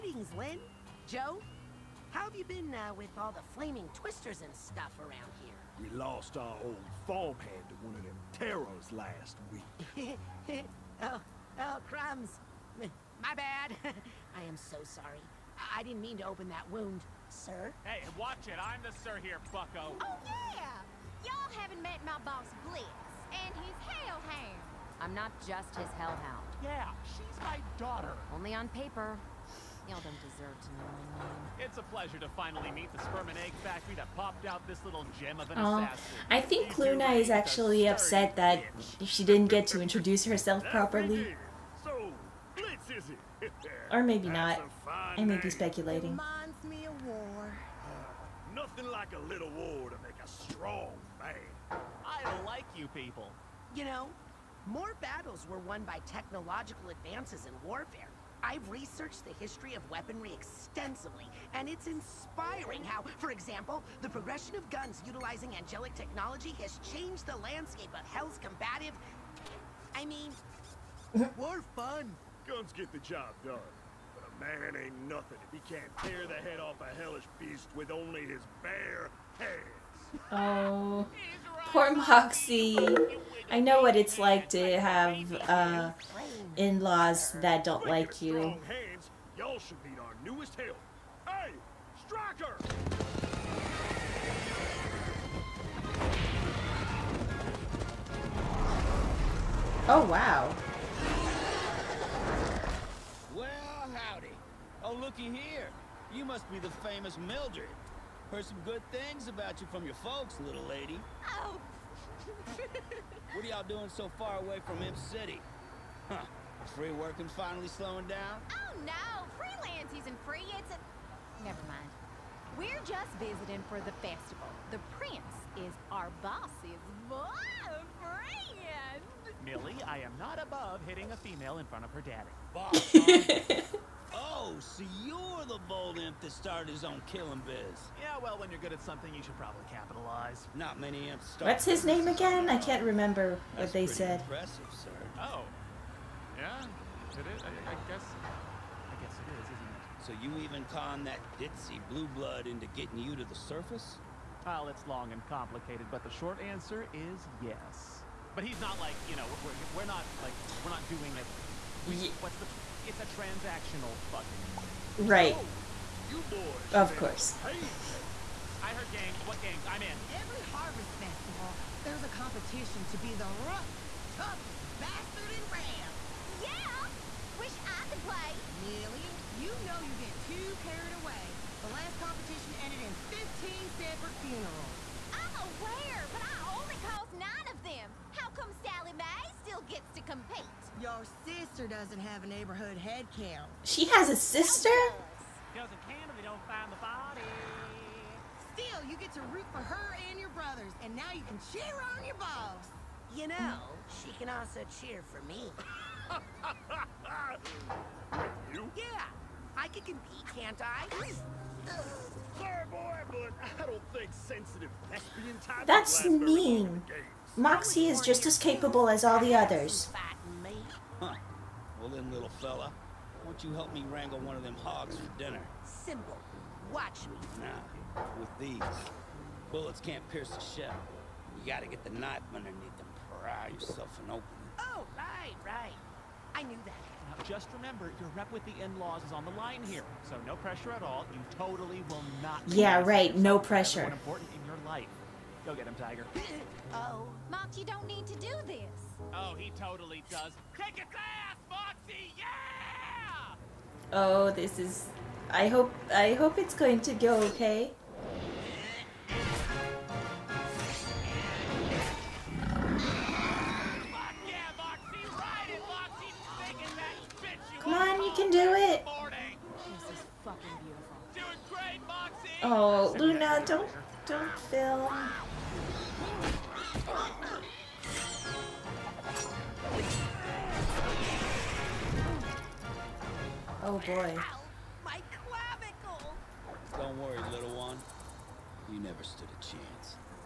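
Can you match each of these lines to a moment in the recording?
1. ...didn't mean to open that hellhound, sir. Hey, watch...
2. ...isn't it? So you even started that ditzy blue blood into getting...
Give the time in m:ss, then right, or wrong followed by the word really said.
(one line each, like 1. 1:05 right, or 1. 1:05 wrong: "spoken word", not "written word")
1. 0:15 wrong: "wound", not "hellhound"
2. 2:29 wrong: "conned", not "started".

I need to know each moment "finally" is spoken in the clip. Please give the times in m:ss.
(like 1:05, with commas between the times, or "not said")
0:32, 1:57.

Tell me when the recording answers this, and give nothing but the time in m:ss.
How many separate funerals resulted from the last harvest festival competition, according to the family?
3:03.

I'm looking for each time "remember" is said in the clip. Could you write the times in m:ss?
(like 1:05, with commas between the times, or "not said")
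2:22, 3:57.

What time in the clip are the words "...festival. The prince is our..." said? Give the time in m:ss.
2:04.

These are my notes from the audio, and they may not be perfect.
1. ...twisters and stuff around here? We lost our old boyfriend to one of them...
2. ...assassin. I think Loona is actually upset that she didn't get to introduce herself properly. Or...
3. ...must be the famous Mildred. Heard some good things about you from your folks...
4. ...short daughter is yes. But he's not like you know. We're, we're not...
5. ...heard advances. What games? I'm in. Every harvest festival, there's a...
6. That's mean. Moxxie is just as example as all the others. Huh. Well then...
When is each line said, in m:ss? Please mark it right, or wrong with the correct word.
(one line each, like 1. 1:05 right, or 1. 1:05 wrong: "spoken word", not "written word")
1. 0:03 wrong: "farmhand", not "boyfriend"
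2. 0:35 right
3. 1:46 right
4. 2:36 wrong: "answer", not "daughter"
5. 2:48 wrong: "games", not "advances"
6. 3:35 wrong: "capable", not "example".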